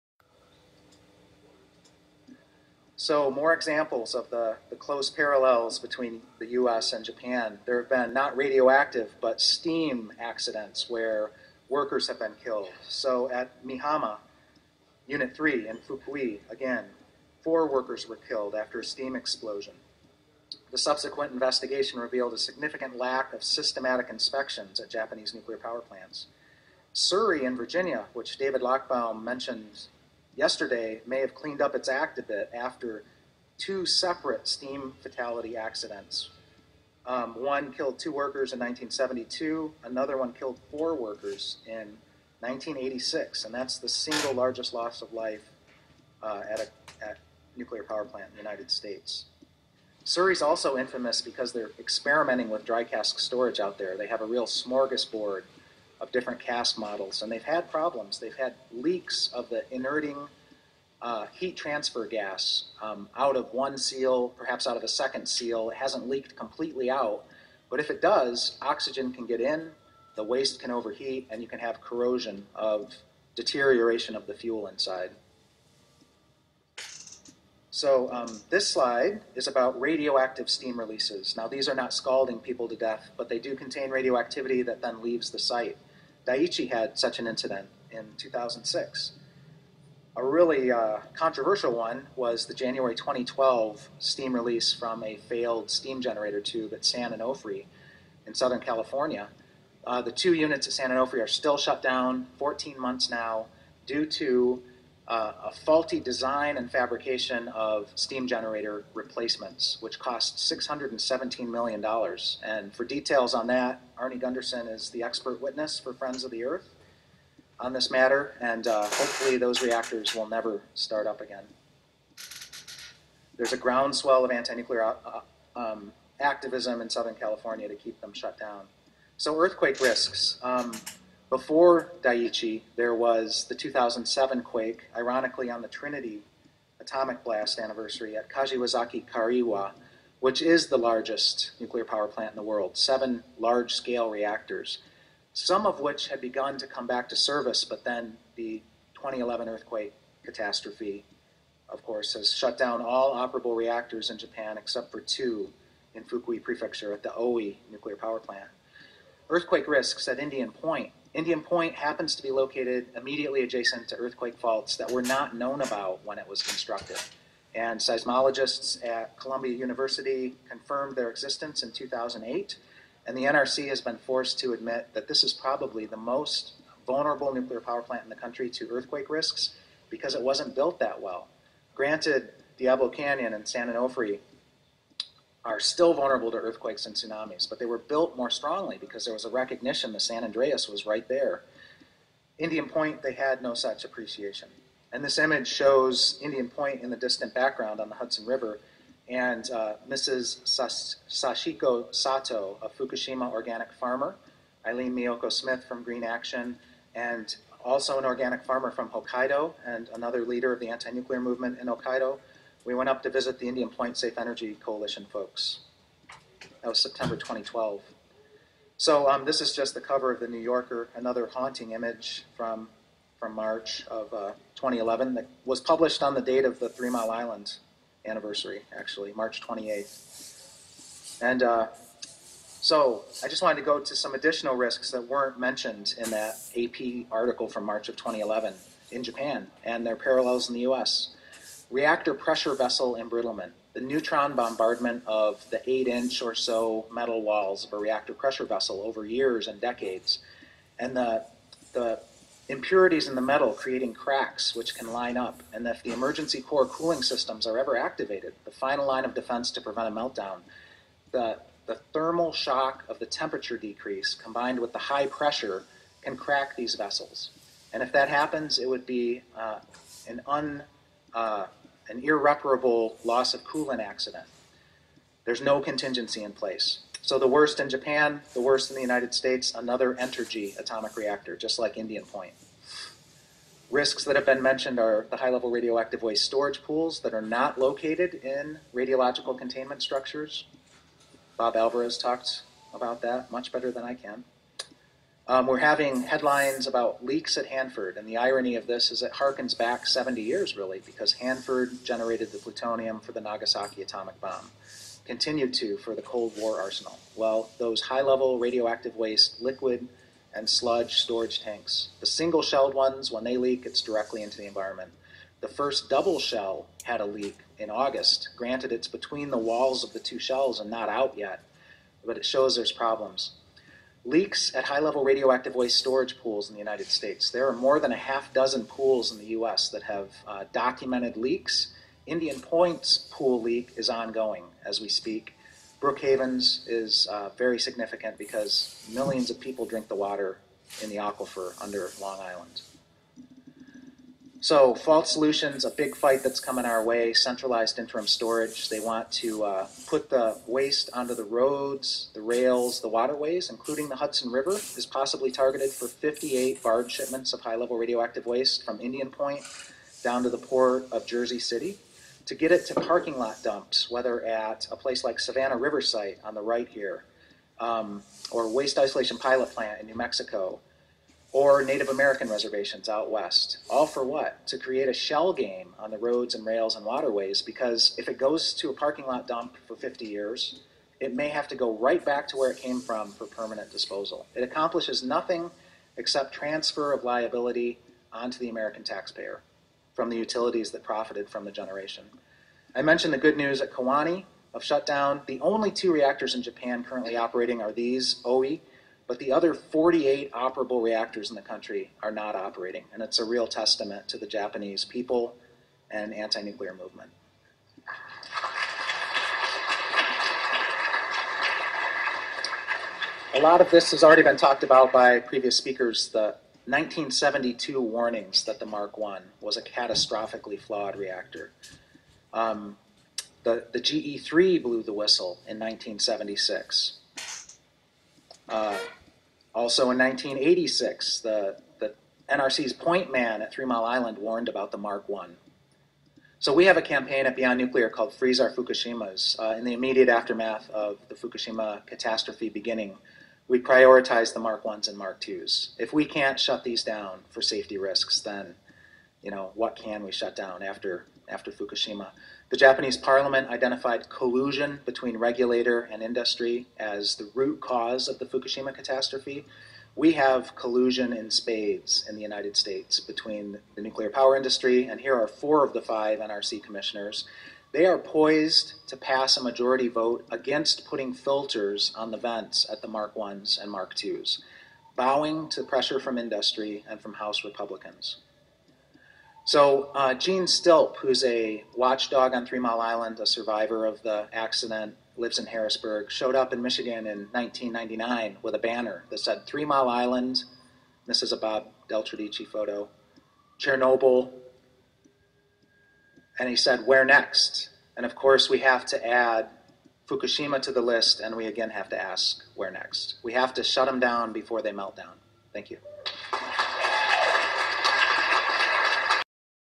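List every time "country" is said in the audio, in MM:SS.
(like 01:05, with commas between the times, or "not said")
02:58, 06:41.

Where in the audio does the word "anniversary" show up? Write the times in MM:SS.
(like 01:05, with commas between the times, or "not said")
02:17, 03:48.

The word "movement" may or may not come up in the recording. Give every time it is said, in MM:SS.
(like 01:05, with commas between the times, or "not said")
03:31, 06:46.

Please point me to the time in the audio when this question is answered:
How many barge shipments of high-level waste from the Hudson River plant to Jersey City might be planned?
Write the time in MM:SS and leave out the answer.
05:55.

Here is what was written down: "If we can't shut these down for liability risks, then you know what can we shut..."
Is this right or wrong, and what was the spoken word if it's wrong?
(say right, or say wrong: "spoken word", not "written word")
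wrong: "safety", not "liability".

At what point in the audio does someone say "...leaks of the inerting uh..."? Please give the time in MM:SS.
00:58.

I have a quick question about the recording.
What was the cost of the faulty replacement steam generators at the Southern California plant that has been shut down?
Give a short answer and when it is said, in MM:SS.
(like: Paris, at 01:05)
$617 million, at 01:50.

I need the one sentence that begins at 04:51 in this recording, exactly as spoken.
Bob Alvarez talked about that much better than I can.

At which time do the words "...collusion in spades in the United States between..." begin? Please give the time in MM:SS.
07:40.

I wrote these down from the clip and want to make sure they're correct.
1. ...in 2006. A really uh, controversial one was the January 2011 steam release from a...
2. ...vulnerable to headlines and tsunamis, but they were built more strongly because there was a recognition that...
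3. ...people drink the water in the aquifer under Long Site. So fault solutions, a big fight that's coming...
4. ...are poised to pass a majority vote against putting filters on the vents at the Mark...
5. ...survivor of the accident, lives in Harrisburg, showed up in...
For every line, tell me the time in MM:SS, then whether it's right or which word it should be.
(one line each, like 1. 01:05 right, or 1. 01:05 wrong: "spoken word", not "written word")
1. 01:27 wrong: "2012", not "2011"
2. 03:05 wrong: "earthquakes", not "headlines"
3. 05:39 wrong: "Island", not "Site"
4. 07:47 right
5. 08:03 right.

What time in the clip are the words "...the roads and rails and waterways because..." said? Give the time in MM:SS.
06:15.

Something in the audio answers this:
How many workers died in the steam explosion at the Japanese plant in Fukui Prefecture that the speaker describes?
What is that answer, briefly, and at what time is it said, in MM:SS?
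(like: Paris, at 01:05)
4, at 00:17.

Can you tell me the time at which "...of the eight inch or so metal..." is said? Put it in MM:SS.
04:05.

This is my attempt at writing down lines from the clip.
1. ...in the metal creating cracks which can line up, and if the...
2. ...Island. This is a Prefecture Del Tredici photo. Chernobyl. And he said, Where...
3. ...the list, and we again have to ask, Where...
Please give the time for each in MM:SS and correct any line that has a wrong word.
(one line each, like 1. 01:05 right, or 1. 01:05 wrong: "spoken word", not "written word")
1. 04:13 right
2. 08:09 wrong: "Bob", not "Prefecture"
3. 08:20 right.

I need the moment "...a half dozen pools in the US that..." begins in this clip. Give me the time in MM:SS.
05:27.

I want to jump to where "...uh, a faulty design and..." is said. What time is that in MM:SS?
01:45.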